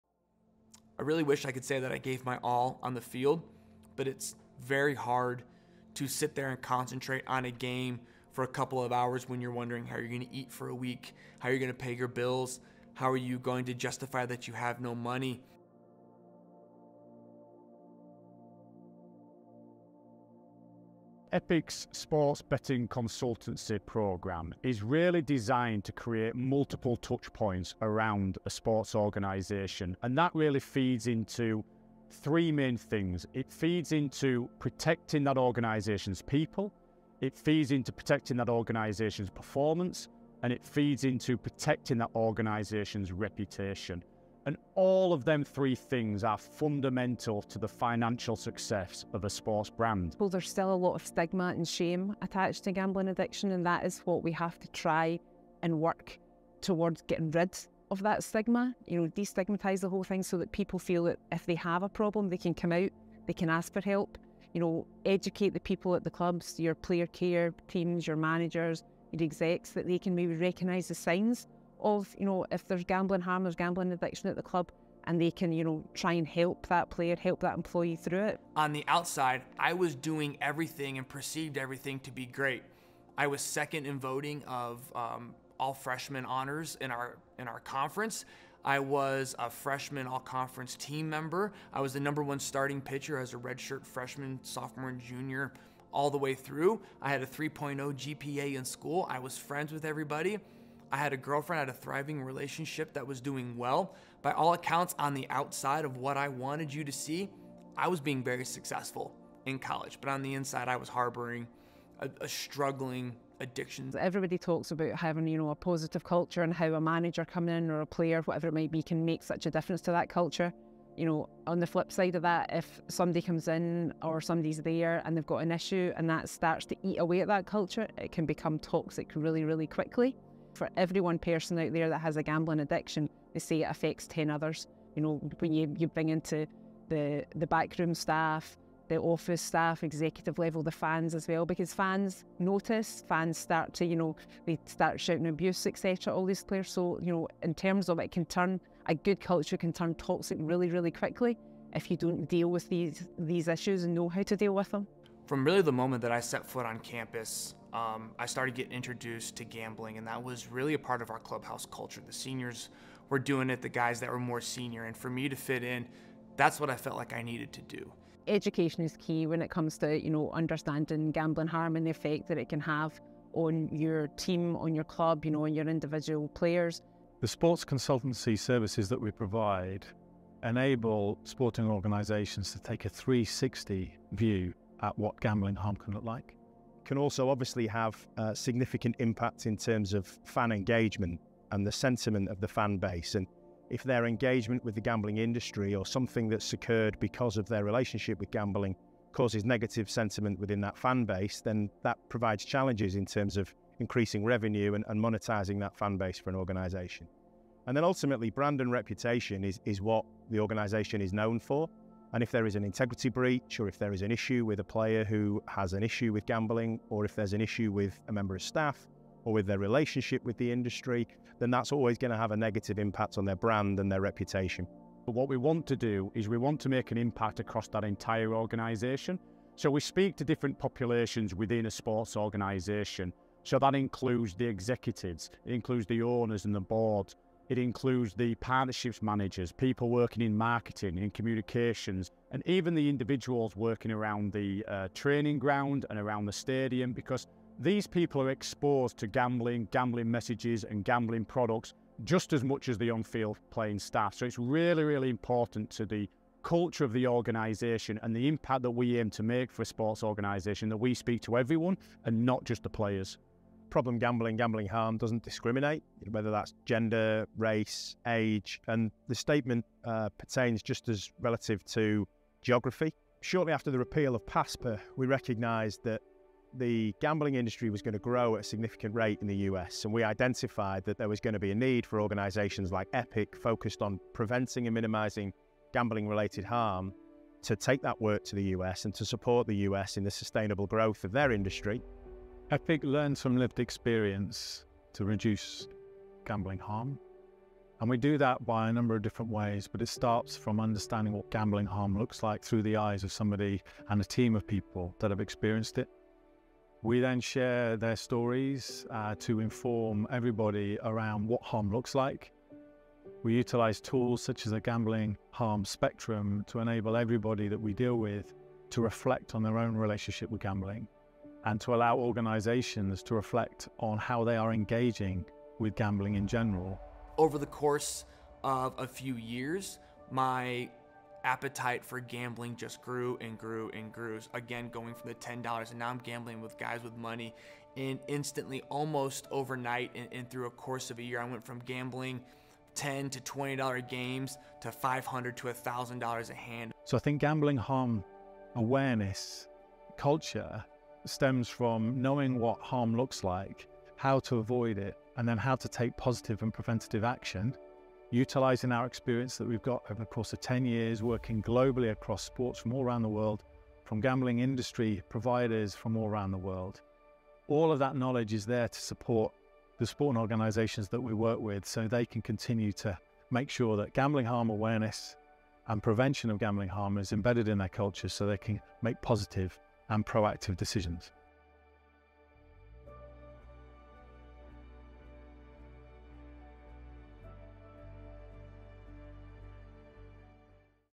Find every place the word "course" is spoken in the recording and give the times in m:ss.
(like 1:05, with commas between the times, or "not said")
5:27, 5:40, 6:00.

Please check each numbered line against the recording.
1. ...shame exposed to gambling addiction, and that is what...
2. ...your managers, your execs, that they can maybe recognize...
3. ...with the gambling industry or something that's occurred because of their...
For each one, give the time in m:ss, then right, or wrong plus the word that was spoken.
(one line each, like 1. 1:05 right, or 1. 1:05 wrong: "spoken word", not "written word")
1. 0:51 wrong: "attached", not "exposed"
2. 1:08 right
3. 3:14 right.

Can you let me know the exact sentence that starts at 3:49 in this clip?
So we speak to different populations within a sports organisation.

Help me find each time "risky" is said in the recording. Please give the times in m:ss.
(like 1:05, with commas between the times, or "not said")
not said.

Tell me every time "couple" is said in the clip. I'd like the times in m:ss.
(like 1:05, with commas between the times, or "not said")
0:08.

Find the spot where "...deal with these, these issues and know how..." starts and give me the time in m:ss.
2:32.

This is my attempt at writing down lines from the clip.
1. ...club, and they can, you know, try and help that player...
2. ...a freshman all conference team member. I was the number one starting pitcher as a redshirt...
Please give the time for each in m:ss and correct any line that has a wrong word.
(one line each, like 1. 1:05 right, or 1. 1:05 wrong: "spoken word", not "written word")
1. 1:14 right
2. 1:29 right.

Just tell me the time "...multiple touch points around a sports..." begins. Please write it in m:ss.
0:26.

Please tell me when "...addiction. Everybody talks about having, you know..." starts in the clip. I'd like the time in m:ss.
1:53.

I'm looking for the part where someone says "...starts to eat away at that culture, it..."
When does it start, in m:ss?
2:06.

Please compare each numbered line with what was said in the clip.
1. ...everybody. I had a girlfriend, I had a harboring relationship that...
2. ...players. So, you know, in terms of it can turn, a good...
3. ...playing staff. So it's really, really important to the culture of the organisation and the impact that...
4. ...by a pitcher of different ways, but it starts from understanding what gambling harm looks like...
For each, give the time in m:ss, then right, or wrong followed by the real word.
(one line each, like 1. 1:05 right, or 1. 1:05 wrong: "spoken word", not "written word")
1. 1:39 wrong: "thriving", not "harboring"
2. 2:26 right
3. 4:13 right
4. 4:58 wrong: "number", not "pitcher".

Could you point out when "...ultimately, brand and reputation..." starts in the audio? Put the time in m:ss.
3:27.